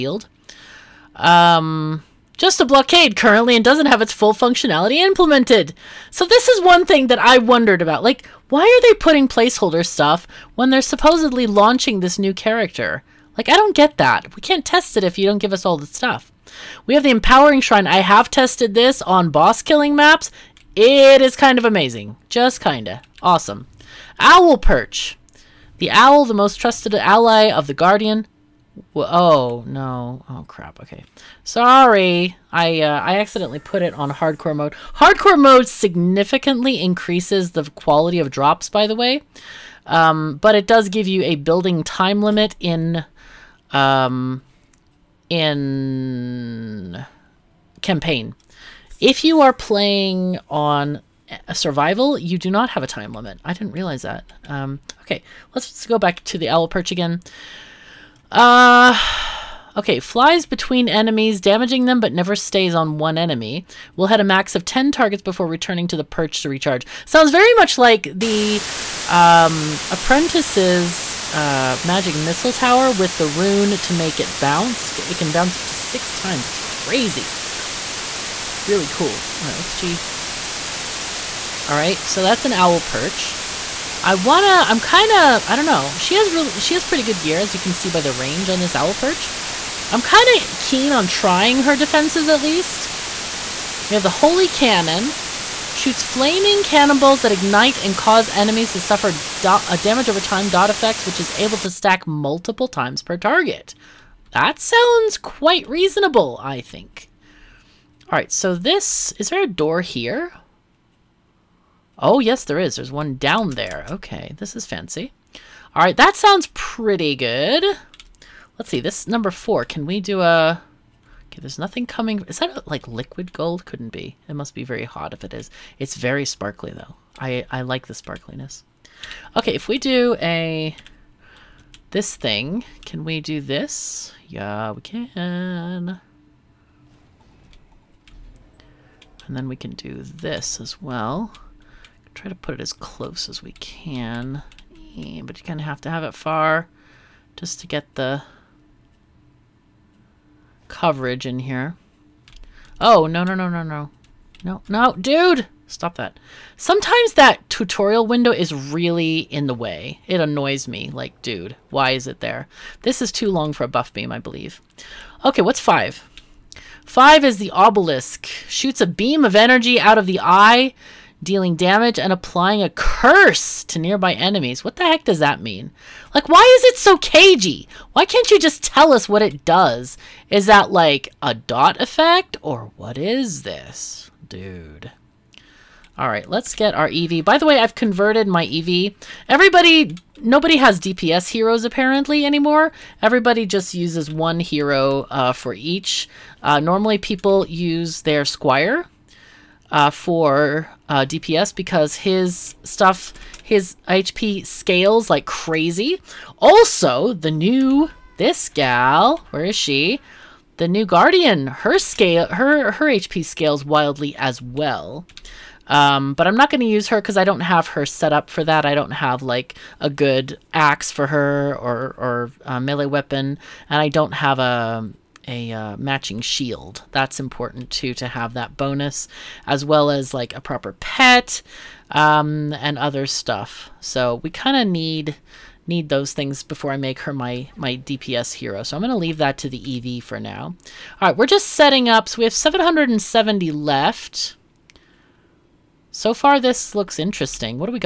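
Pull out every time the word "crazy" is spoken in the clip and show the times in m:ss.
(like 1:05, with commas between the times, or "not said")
1:16, 3:25.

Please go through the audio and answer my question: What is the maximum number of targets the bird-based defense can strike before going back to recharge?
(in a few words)
10.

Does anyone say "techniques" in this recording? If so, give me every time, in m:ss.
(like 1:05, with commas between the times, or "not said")
not said.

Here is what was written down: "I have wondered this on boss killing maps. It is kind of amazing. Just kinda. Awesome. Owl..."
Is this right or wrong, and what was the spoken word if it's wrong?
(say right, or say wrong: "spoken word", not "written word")
wrong: "tested", not "wondered".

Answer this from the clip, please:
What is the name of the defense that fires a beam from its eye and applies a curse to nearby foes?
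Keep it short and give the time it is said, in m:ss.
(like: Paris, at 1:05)
Obelisk, at 2:47.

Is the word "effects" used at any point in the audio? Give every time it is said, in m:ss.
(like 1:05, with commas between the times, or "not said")
1:40, 3:01.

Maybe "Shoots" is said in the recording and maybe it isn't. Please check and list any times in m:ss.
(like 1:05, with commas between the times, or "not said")
1:35, 2:48.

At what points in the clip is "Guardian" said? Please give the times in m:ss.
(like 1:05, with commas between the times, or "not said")
0:27, 3:30.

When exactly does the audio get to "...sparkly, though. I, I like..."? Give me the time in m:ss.
2:06.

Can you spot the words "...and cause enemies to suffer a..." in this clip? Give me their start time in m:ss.
1:37.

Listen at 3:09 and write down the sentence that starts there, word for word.
Everybody, nobody has DPS heroes apparently anymore.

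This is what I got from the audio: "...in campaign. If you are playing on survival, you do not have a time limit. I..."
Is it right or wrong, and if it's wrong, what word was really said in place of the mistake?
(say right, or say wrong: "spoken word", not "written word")
right.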